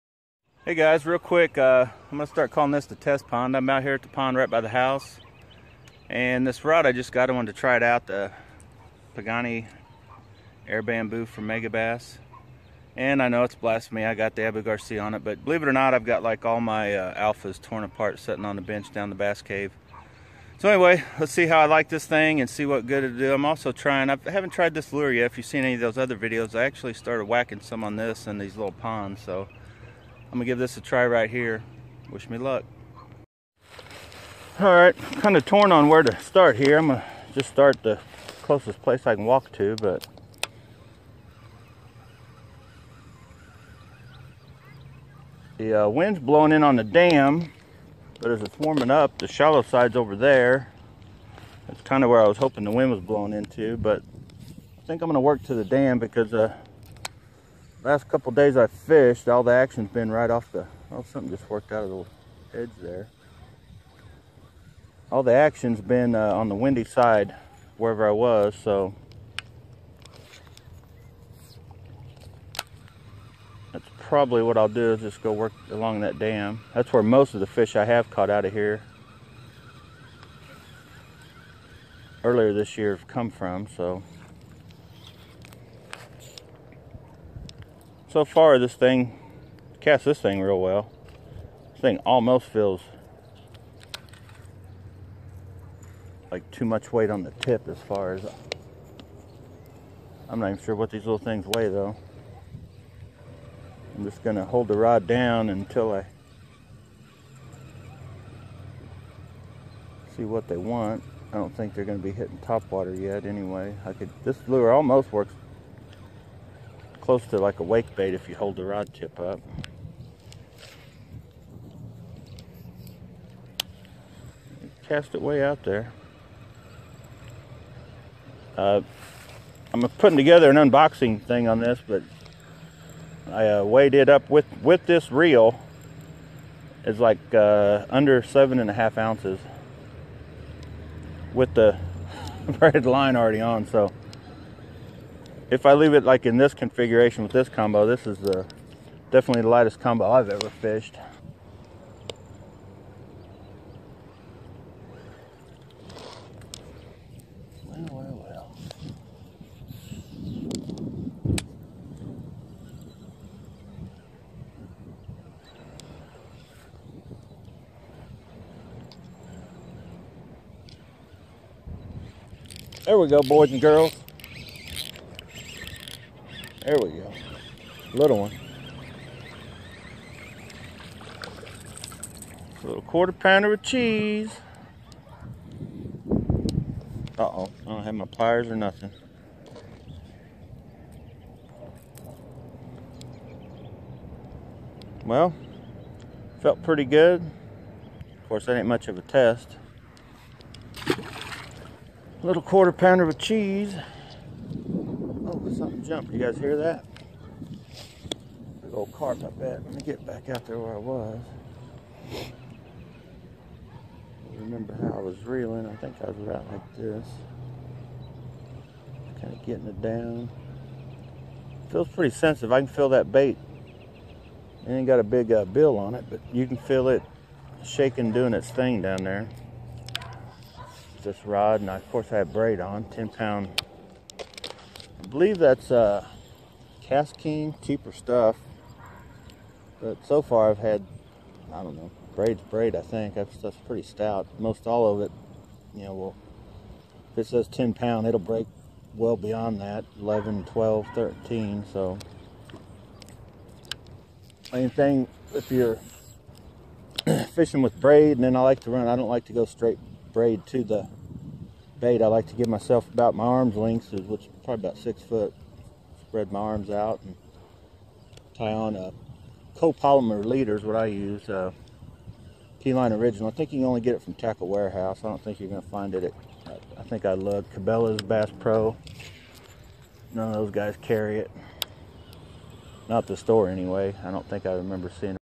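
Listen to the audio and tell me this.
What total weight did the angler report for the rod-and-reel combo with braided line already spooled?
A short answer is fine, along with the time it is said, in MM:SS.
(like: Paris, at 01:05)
under 7.5 ounces, at 02:17.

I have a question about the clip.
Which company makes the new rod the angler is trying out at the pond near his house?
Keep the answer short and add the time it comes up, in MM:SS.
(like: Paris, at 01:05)
Megabass, at 00:11.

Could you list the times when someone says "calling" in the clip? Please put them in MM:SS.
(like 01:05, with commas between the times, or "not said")
00:02.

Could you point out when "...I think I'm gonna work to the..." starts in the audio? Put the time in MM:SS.
00:54.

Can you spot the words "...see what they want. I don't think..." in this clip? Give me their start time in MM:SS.
01:50.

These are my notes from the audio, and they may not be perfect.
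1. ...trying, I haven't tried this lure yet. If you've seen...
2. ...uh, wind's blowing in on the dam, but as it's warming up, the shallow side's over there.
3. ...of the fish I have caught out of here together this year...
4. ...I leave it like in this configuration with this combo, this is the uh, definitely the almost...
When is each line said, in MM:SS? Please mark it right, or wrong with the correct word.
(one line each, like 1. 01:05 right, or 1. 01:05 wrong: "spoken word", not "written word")
1. 00:23 right
2. 00:45 right
3. 01:17 wrong: "earlier", not "together"
4. 02:25 wrong: "lightest", not "almost".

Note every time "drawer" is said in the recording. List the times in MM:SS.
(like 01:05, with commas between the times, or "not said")
not said.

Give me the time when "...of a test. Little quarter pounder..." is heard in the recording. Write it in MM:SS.
03:18.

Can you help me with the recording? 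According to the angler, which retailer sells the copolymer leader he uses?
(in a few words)
Tackle Warehouse.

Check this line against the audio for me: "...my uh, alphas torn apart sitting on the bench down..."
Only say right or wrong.
right.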